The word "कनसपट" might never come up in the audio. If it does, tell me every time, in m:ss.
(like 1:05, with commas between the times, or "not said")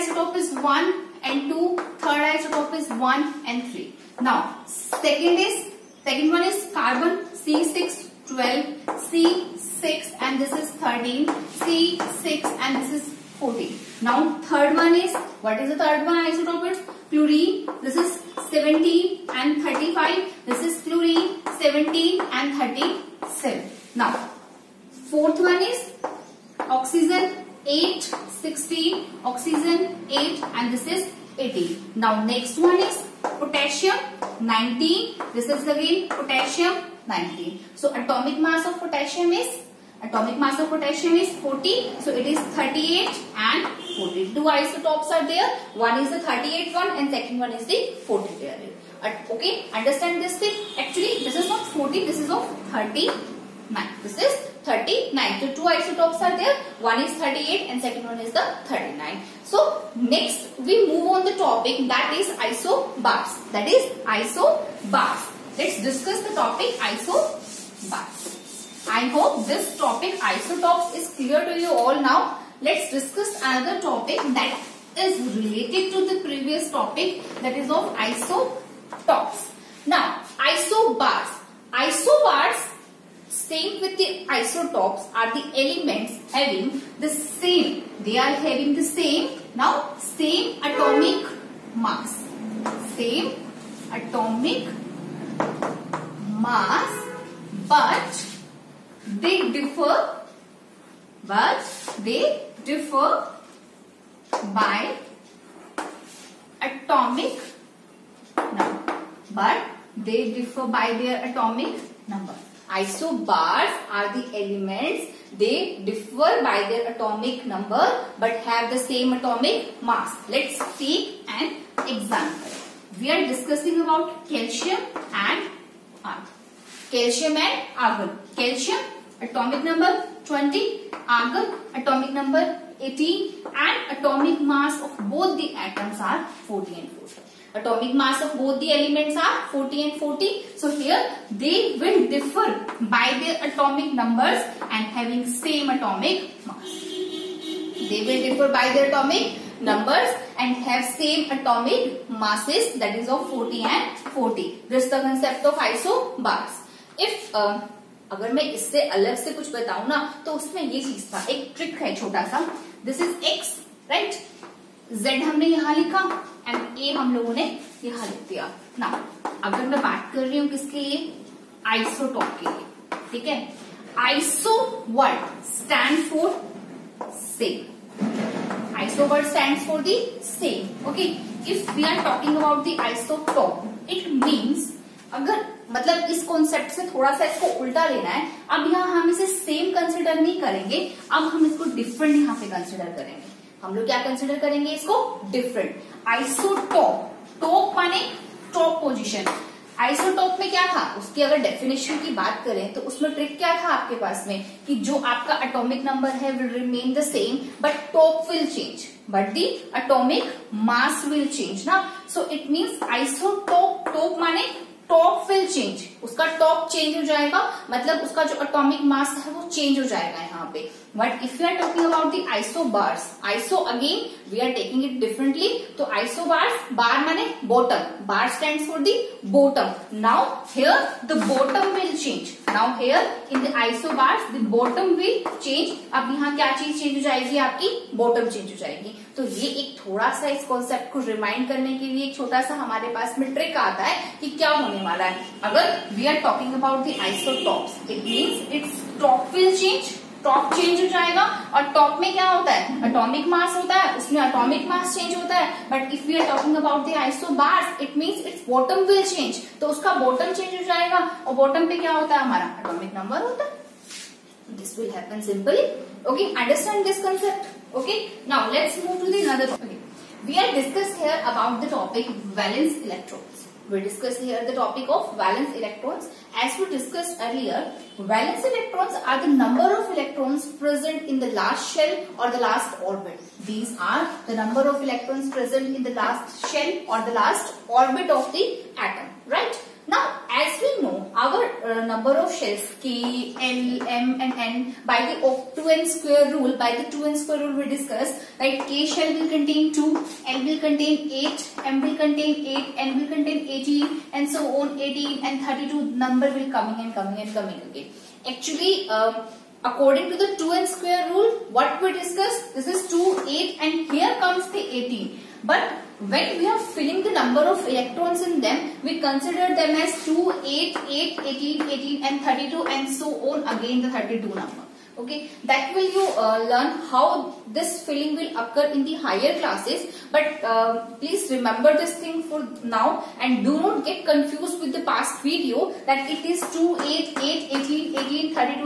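3:06, 4:00.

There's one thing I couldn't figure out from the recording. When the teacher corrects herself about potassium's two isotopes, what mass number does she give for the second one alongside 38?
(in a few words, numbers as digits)
39.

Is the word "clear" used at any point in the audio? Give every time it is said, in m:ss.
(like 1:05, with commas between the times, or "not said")
1:11.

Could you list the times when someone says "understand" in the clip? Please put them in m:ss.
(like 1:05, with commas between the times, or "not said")
0:49, 4:26.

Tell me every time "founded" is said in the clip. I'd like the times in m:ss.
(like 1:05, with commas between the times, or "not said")
not said.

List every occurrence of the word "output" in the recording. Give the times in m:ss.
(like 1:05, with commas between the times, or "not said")
not said.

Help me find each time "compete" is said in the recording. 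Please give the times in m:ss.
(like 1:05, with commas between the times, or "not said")
not said.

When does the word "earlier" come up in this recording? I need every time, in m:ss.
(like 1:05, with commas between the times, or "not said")
4:37.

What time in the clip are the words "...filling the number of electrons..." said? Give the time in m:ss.
5:16.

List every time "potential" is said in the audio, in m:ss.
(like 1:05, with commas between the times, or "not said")
not said.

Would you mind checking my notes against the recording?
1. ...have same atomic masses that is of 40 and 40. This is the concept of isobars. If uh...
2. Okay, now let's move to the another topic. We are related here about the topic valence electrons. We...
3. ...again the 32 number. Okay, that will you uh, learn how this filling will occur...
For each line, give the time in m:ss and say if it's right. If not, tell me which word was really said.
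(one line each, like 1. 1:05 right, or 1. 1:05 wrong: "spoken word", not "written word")
1. 2:30 right
2. 4:27 wrong: "discussed", not "related"
3. 5:23 right.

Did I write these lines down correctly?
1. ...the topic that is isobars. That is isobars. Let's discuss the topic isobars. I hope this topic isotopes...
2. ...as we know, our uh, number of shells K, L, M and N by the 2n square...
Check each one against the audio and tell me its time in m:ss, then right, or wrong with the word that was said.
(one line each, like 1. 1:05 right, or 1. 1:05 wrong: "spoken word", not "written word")
1. 1:01 right
2. 4:50 right.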